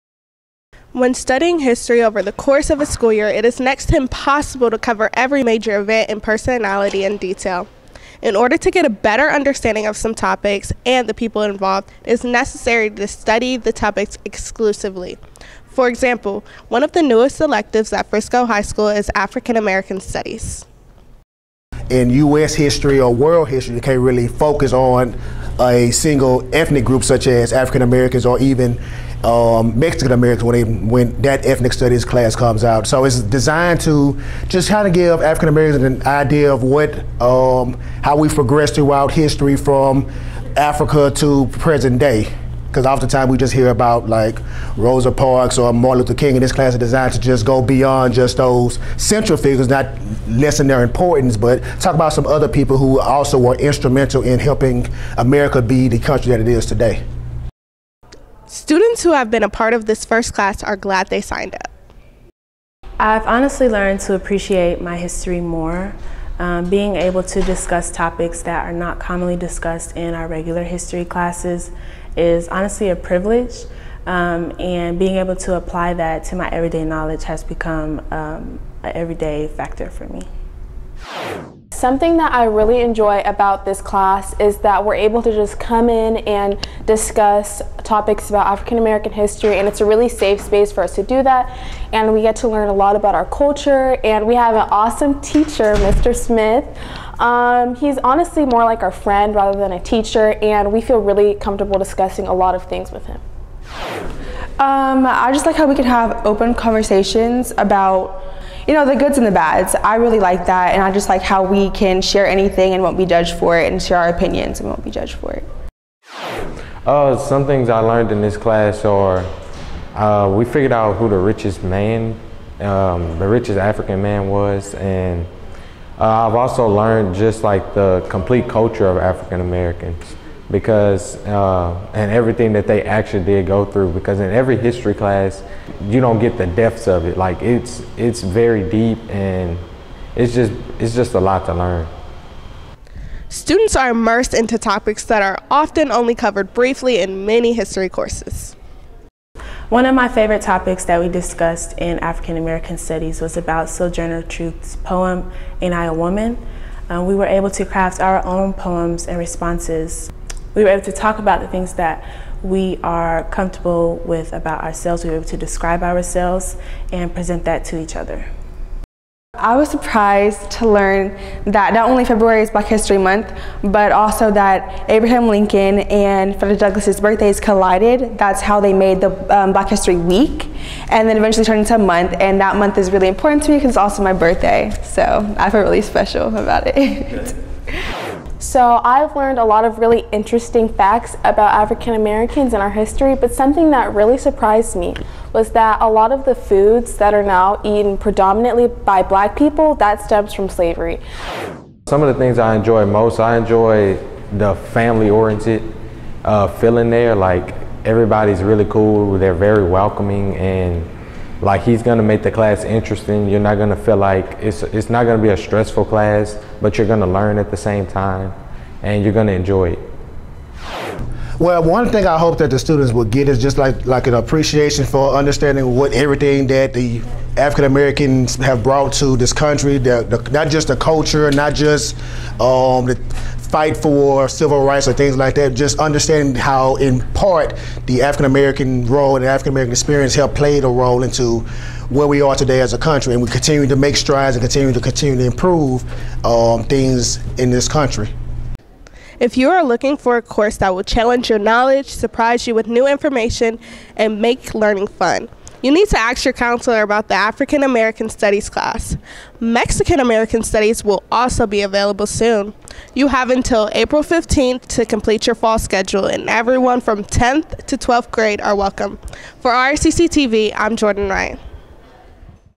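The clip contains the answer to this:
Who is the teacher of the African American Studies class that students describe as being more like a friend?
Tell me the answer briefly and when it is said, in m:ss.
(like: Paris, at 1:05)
Mr. Smith, at 1:35.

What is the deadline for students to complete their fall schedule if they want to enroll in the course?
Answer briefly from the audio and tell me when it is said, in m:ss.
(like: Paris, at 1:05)
April 15th, at 4:23.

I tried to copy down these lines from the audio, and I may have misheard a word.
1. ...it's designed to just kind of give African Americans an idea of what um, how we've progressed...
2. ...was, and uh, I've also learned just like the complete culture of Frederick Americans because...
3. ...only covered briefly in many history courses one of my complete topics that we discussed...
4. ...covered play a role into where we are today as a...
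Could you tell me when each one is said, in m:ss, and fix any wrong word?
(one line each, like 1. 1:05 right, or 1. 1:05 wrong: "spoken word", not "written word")
1. 0:33 right
2. 2:04 wrong: "African", not "Frederick"
3. 2:25 wrong: "favorite", not "complete"
4. 4:00 wrong: "helped", not "covered".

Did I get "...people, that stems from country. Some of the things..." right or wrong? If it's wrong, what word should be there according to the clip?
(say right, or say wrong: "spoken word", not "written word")
wrong: "slavery", not "country".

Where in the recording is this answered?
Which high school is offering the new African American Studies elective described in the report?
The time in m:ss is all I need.
0:18.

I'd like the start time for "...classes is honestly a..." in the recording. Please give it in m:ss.
1:11.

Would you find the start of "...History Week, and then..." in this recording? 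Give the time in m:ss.
2:59.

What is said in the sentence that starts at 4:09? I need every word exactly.
If you are looking for a course that will challenge your knowledge, surprise you with new information, and make learning fun.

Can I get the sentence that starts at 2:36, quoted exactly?
Um, we were able to craft our own poems and responses.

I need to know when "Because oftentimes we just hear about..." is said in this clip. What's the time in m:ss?
0:42.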